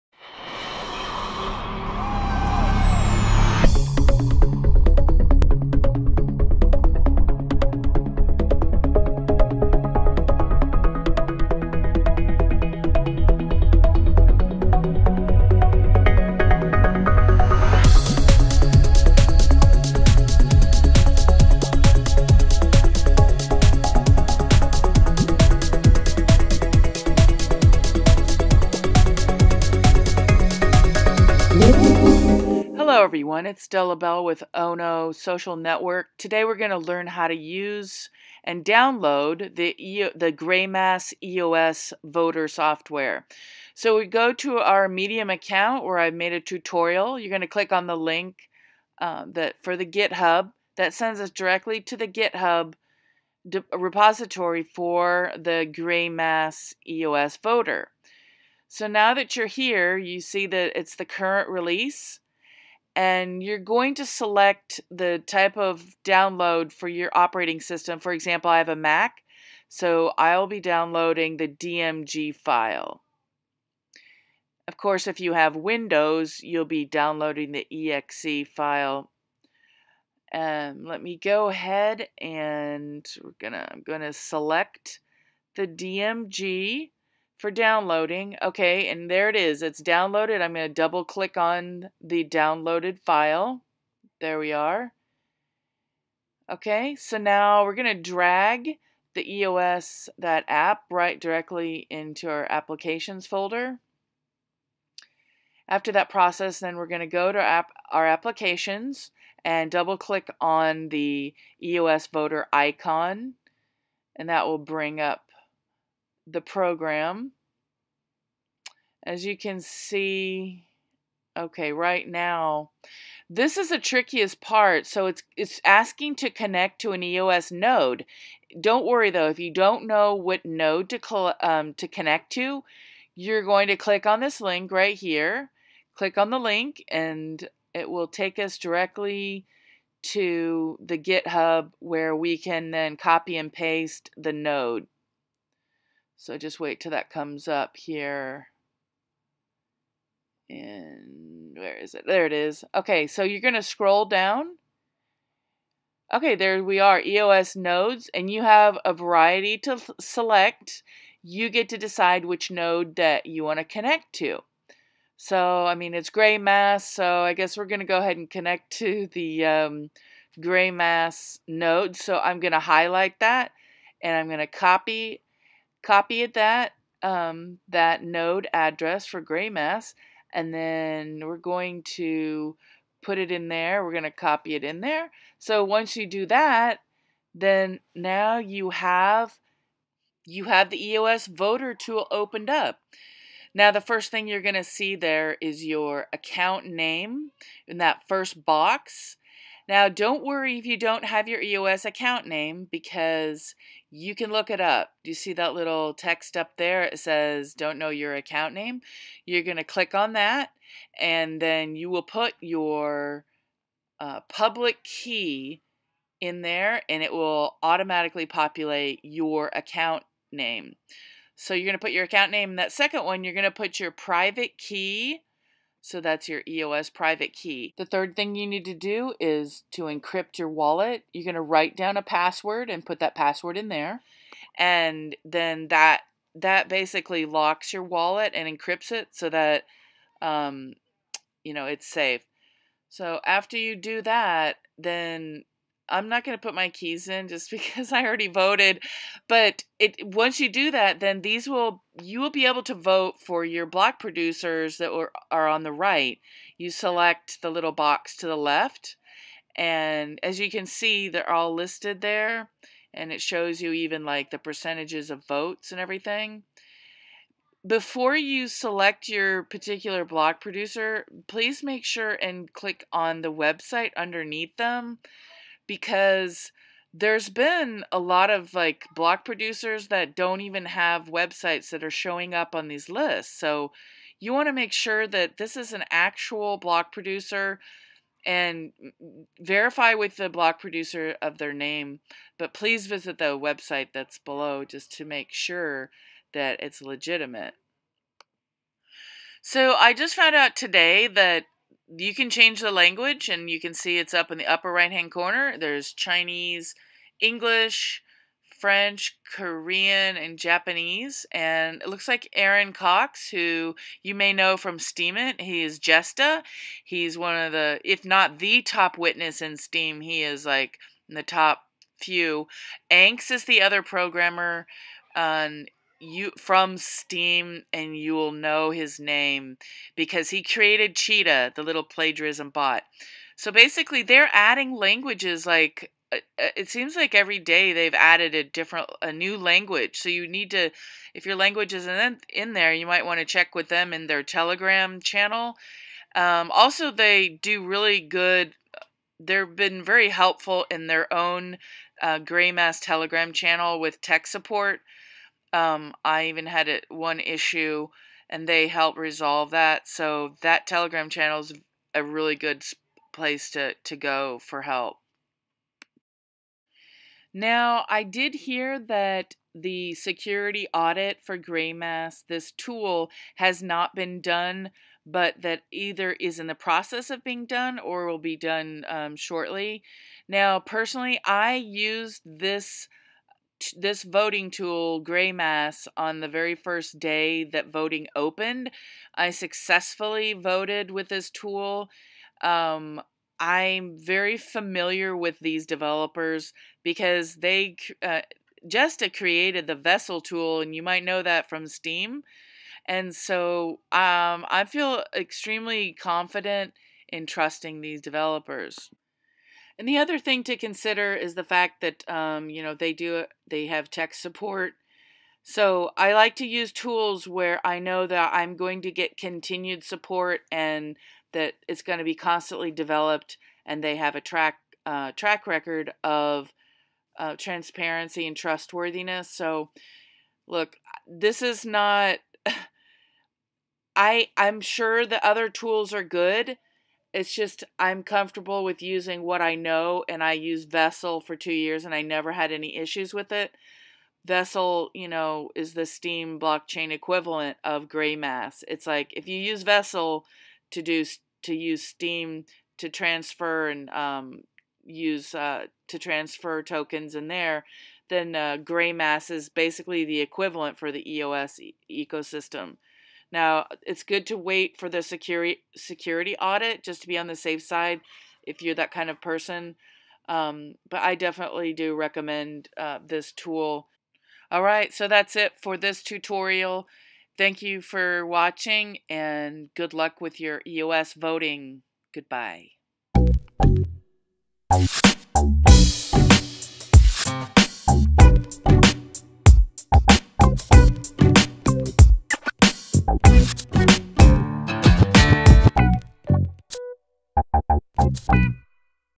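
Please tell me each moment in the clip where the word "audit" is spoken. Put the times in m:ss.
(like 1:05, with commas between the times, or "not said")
6:10, 7:46.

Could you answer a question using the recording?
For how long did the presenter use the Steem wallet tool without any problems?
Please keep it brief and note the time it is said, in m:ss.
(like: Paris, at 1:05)
2 years, at 7:21.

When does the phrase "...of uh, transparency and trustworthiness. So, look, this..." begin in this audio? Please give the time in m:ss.
7:06.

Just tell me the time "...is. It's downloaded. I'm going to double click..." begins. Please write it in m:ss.
1:29.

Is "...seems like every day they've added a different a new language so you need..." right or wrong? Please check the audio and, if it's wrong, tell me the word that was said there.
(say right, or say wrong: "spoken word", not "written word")
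right.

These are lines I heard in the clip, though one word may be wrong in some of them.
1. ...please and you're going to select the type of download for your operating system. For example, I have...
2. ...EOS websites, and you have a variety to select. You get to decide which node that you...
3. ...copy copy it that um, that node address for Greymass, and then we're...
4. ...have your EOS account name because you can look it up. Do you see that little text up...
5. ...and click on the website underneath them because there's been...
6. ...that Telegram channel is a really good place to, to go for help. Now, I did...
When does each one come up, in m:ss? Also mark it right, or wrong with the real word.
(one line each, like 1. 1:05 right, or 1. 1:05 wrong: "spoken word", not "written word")
1. 1:01 wrong: "release", not "please"
2. 2:37 wrong: "nodes", not "websites"
3. 2:54 right
4. 3:21 right
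5. 4:32 right
6. 6:00 right.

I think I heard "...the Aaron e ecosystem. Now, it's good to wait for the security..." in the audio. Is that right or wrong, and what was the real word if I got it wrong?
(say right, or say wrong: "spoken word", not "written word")
wrong: "EOS", not "Aaron".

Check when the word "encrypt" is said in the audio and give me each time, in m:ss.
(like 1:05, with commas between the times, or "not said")
3:49, 3:58.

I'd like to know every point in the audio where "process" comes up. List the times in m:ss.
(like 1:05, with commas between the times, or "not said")
1:46, 6:16.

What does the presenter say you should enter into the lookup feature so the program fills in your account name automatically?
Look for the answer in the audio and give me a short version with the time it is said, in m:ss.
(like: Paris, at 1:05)
public key, at 3:34.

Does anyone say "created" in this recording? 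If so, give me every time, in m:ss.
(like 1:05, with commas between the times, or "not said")
5:30, 6:39.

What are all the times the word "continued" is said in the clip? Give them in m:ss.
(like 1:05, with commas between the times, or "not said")
6:59.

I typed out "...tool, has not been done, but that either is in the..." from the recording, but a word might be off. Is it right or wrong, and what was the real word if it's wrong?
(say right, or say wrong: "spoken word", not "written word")
right.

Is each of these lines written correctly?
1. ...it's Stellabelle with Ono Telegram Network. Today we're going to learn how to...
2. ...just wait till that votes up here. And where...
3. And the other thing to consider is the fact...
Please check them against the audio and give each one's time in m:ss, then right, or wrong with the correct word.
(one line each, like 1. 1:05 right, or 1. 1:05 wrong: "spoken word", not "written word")
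1. 0:33 wrong: "Social", not "Telegram"
2. 2:26 wrong: "comes", not "votes"
3. 6:49 right.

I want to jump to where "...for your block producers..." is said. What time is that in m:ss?
4:13.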